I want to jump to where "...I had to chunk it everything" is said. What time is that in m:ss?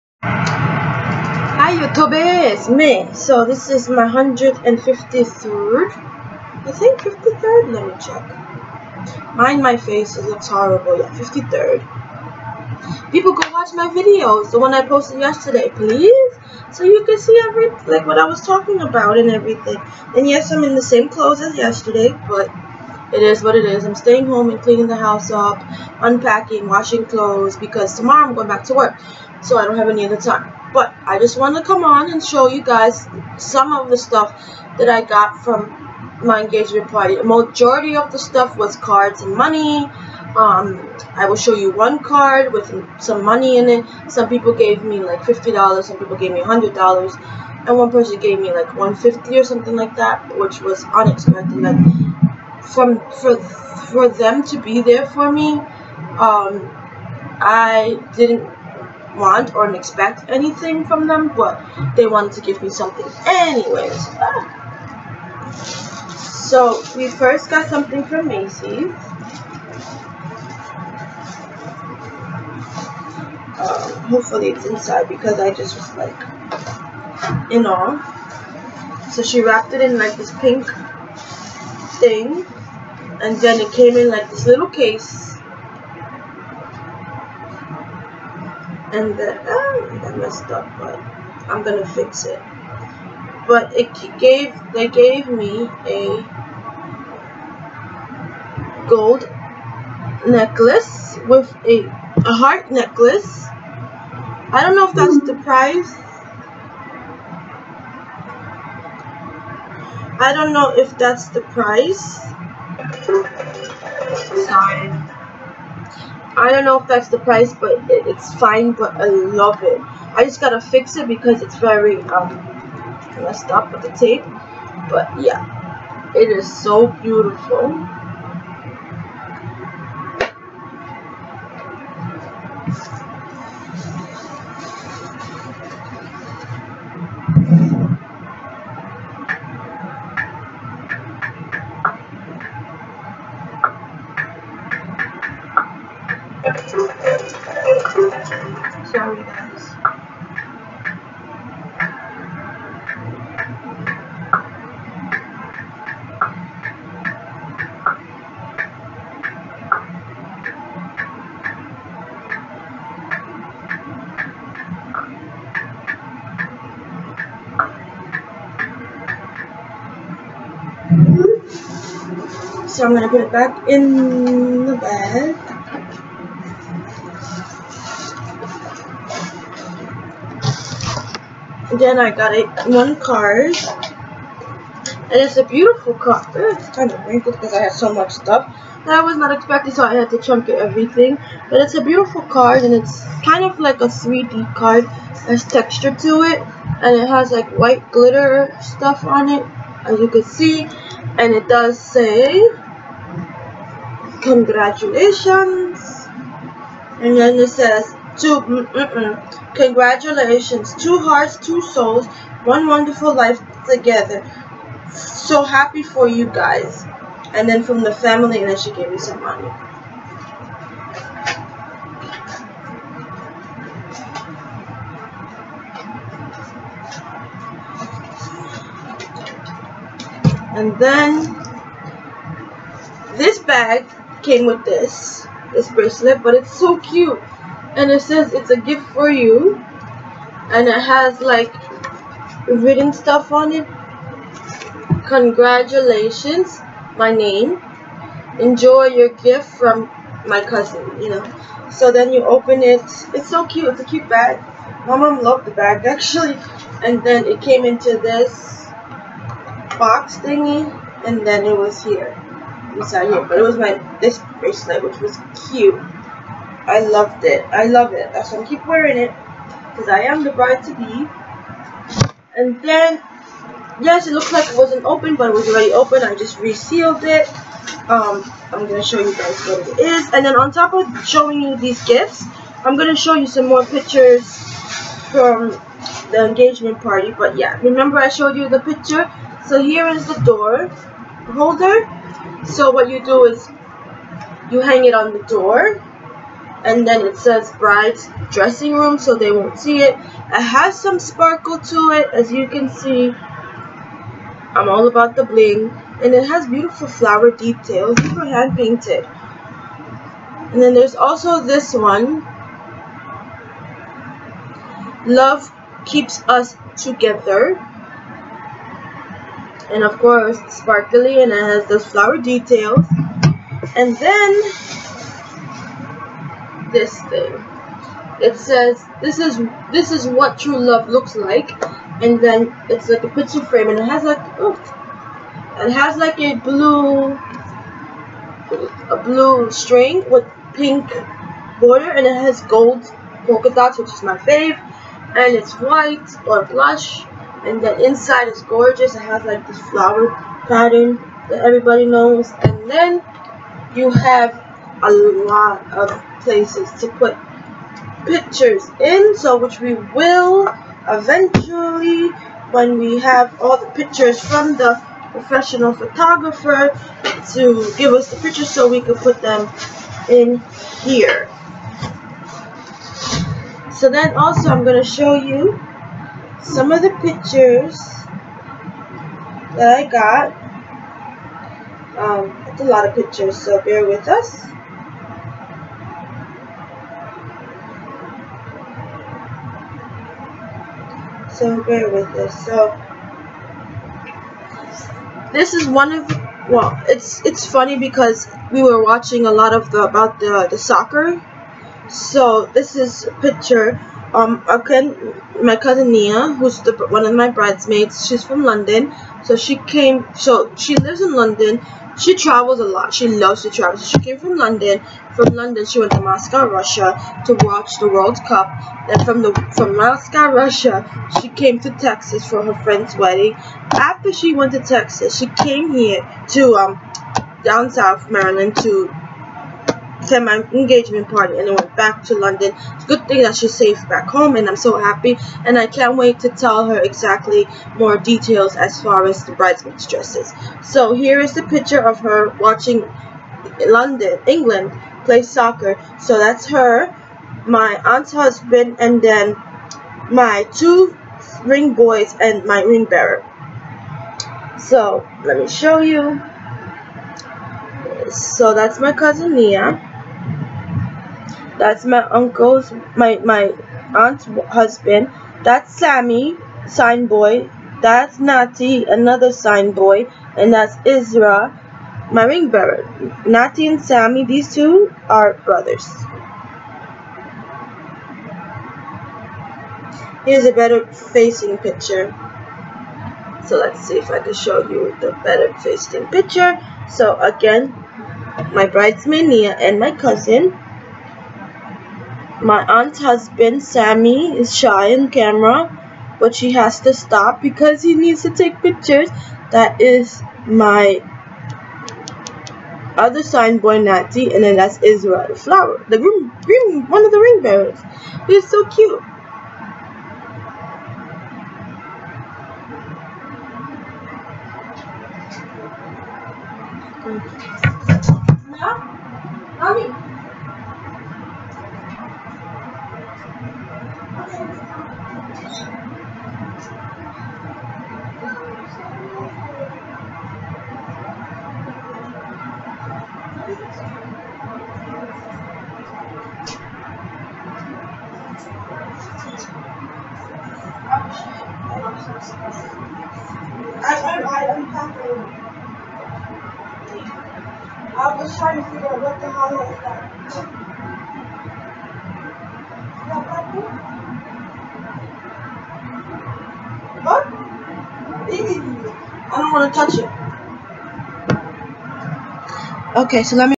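3:09.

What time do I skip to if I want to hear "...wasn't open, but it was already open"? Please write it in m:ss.
4:34.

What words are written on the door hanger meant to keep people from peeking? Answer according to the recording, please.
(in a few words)
bride's dressing room.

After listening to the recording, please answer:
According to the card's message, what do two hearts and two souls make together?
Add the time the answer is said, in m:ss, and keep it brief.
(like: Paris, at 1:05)
one wonderful life, at 3:32.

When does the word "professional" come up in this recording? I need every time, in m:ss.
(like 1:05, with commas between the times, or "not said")
6:05.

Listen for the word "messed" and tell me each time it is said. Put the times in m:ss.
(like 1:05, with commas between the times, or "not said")
1:30, 2:03.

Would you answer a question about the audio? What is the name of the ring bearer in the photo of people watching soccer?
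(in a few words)
Isra.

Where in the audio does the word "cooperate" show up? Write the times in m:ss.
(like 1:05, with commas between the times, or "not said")
not said.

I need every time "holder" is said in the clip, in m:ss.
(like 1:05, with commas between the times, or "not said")
4:51.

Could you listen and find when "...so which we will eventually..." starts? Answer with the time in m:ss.
5:59.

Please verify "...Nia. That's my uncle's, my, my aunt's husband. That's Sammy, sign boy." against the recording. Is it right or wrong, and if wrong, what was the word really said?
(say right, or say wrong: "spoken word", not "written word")
right.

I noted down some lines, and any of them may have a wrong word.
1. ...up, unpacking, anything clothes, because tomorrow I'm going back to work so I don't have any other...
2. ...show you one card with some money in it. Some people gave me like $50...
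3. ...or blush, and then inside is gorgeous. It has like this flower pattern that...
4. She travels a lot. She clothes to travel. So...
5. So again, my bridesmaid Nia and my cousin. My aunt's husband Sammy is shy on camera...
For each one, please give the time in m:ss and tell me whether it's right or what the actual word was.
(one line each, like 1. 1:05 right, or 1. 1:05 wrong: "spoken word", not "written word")
1. 0:25 wrong: "washing", not "anything"
2. 0:41 right
3. 5:46 right
4. 6:51 wrong: "loves", not "clothes"
5. 8:06 right.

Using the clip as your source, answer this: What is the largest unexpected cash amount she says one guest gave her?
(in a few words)
150.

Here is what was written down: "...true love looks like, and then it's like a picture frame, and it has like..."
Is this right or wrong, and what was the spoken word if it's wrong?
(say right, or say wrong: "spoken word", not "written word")
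right.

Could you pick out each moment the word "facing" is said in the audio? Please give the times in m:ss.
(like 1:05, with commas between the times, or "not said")
8:00, 8:05.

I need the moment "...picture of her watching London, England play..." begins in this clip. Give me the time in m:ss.
7:21.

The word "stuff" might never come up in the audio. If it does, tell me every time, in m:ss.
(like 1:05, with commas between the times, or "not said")
0:33, 0:38, 3:08, 3:18, 4:02.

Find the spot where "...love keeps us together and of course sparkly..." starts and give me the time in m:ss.
5:15.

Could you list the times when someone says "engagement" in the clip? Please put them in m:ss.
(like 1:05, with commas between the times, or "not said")
0:36, 4:46, 7:10.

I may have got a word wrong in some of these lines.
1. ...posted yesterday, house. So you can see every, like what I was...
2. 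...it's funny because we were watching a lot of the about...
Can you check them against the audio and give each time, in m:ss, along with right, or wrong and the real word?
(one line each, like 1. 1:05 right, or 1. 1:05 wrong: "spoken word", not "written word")
1. 0:14 wrong: "please", not "house"
2. 6:37 right.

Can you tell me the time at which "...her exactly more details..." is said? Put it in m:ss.
7:16.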